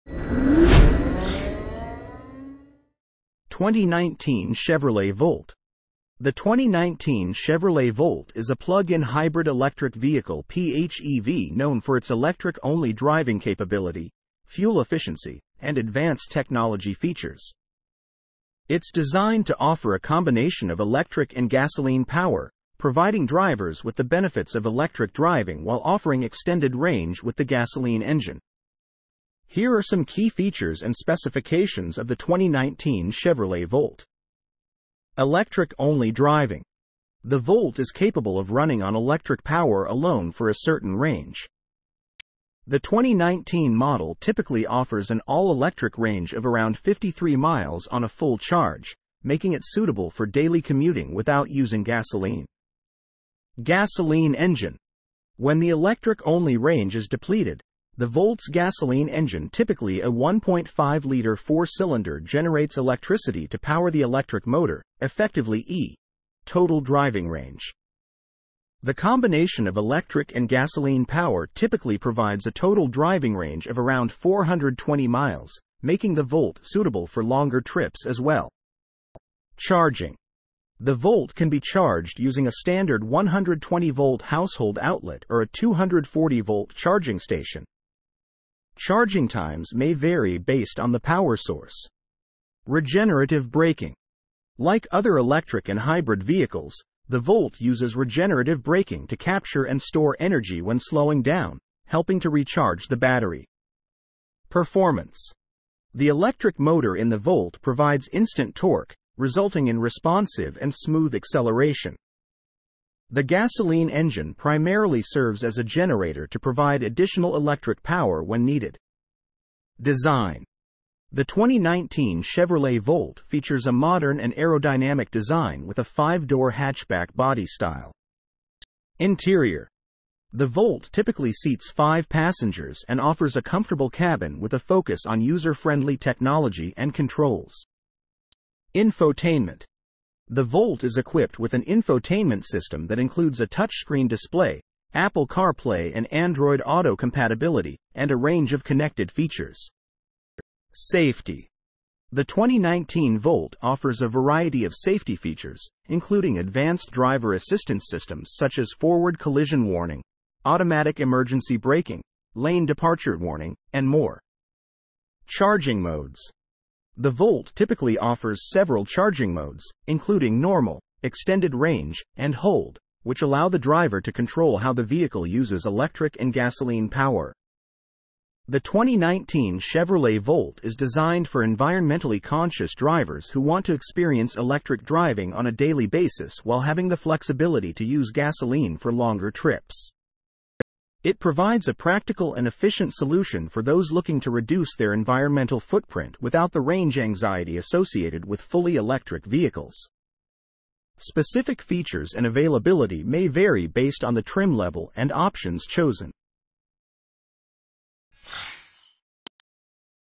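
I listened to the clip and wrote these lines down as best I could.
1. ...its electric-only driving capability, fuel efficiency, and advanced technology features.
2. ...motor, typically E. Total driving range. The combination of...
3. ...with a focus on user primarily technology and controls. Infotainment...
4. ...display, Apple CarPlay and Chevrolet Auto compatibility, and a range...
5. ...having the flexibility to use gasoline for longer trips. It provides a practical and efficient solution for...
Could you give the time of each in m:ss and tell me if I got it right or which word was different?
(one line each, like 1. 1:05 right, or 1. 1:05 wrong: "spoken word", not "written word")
1. 0:11 right
2. 1:04 wrong: "effectively", not "typically"
3. 2:14 wrong: "friendly", not "primarily"
4. 2:24 wrong: "Android", not "Chevrolet"
5. 3:06 right.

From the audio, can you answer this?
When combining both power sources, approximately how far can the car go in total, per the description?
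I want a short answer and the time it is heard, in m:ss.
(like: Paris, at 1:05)
420 miles, at 1:14.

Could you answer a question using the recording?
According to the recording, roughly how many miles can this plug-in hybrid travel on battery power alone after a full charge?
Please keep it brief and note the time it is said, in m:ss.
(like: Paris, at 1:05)
53 miles, at 0:46.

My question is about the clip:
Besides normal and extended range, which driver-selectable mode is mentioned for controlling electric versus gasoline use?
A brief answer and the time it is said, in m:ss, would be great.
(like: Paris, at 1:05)
hold, at 2:52.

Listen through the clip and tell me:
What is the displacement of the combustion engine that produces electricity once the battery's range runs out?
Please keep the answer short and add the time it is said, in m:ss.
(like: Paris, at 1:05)
1.5 liter, at 1:00.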